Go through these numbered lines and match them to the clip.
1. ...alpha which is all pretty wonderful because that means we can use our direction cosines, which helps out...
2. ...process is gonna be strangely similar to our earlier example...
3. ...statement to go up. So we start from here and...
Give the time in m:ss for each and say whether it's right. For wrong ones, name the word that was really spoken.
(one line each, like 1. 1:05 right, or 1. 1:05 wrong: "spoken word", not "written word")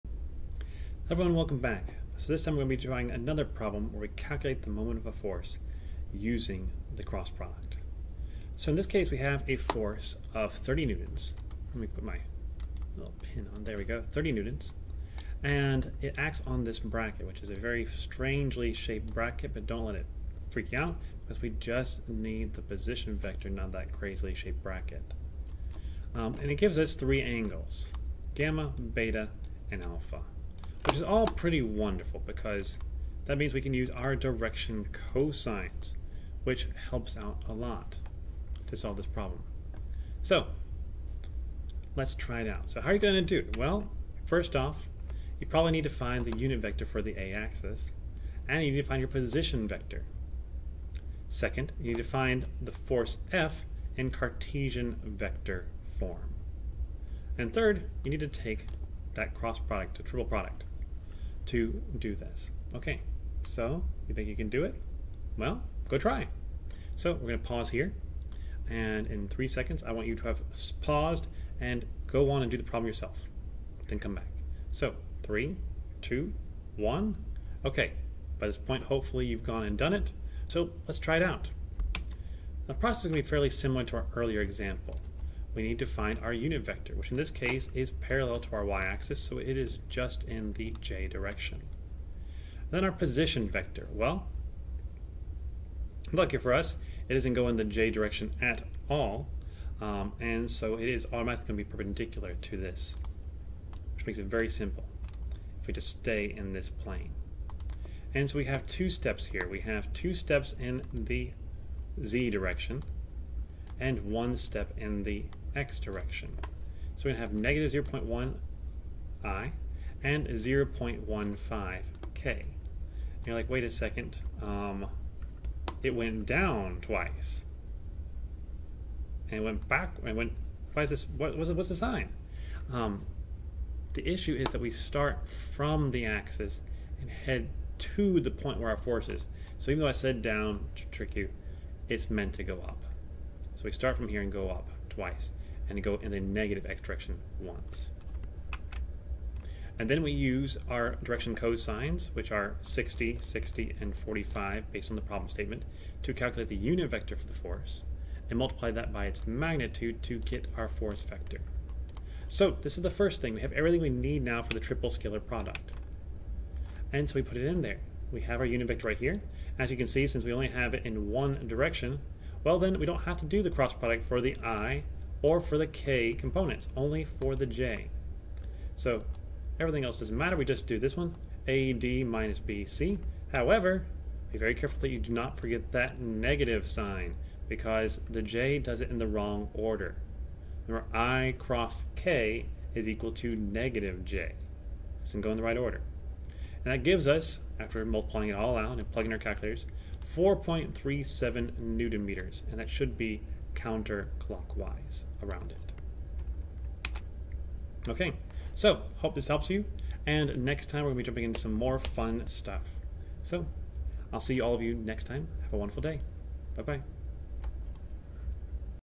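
1. 0:29 right
2. 1:22 wrong: "fairly", not "strangely"
3. 2:22 wrong: "meant", not "statement".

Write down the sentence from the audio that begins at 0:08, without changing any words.
So in this case we have a force of 30 newtons.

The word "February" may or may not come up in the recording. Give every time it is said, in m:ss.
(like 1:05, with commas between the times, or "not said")
not said.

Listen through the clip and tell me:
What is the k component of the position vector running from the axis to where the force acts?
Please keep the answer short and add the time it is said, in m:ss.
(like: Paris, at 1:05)
0.15, at 2:00.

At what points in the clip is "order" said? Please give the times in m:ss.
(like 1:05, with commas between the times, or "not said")
3:09, 3:15.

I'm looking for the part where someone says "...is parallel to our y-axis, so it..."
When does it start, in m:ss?
1:27.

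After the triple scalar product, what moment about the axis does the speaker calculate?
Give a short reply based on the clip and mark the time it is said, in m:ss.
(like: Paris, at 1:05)
4.37 newton meters, at 3:20.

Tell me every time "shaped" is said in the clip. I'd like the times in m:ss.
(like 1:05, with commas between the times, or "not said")
0:18, 0:24.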